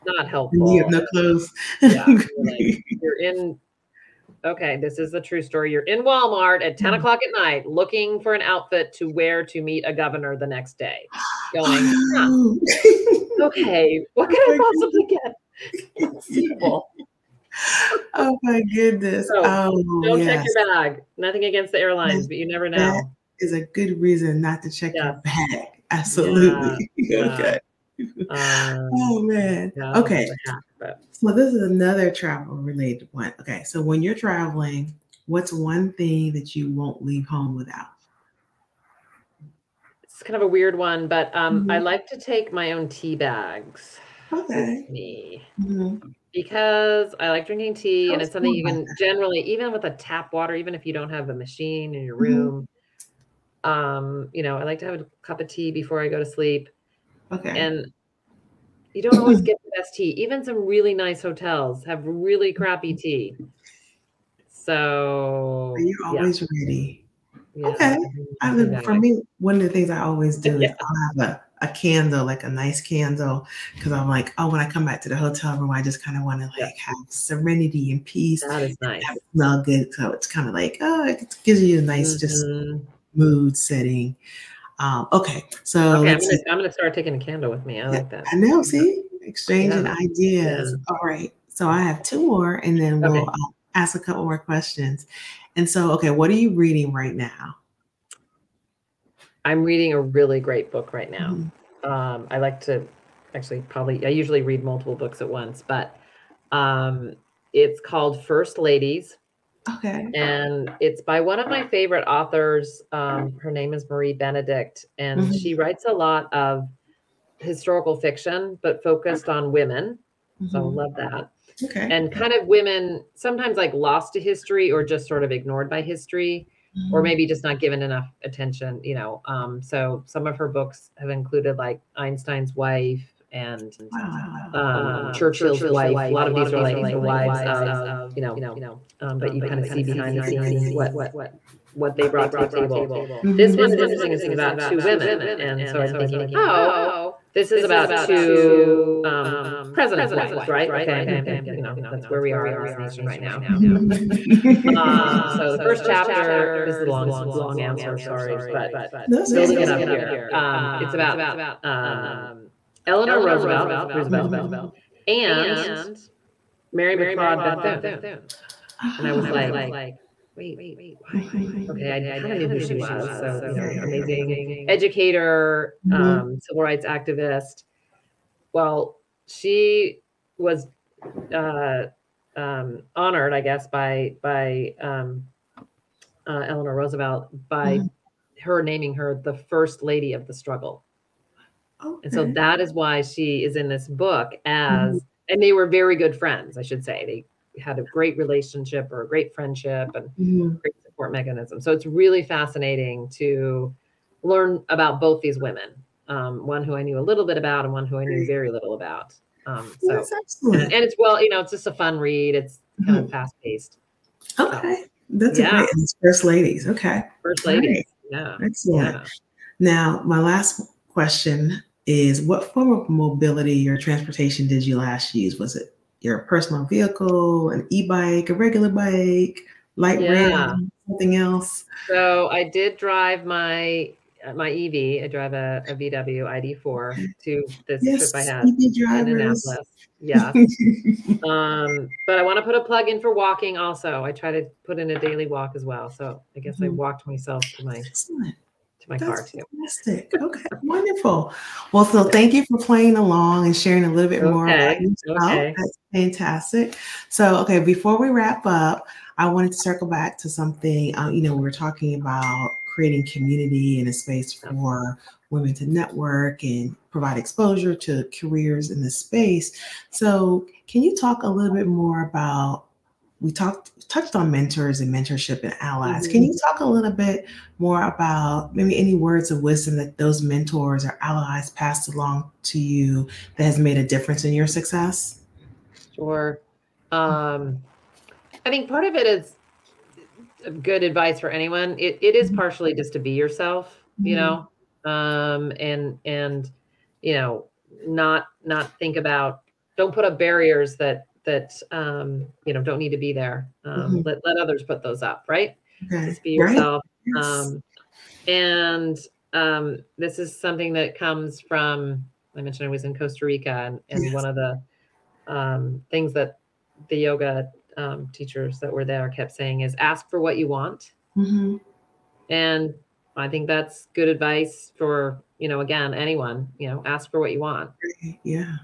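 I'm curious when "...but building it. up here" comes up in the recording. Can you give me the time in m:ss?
2:38.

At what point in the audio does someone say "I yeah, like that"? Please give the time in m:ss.
1:27.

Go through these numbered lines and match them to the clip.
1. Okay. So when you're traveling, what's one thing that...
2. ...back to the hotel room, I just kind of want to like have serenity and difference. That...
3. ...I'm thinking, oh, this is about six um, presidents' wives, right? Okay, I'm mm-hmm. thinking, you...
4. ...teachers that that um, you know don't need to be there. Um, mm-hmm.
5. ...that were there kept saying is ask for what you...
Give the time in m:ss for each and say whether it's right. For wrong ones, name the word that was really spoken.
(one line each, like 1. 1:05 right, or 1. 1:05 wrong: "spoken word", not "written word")
1. 0:33 right
2. 1:14 wrong: "peace", not "difference"
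3. 2:25 wrong: "two", not "six"
4. 5:00 wrong: "barriers", not "teachers"
5. 5:18 right.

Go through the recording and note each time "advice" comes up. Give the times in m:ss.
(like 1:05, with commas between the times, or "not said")
4:50, 5:24.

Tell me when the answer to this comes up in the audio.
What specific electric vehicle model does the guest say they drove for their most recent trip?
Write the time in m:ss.
3:55.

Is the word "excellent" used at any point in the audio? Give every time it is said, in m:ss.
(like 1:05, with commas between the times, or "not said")
3:30, 3:38, 4:07.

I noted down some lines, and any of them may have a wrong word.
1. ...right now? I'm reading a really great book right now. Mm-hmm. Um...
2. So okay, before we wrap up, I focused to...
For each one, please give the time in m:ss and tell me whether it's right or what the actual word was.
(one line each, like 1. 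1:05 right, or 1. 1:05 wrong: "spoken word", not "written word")
1. 1:36 right
2. 4:17 wrong: "wanted", not "focused".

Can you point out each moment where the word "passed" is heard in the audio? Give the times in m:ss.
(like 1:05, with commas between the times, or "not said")
4:41.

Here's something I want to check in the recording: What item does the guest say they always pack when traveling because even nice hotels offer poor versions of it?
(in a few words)
Tea bags.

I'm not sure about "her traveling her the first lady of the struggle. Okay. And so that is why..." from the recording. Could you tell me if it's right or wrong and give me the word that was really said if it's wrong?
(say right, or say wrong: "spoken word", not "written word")
wrong: "naming", not "traveling".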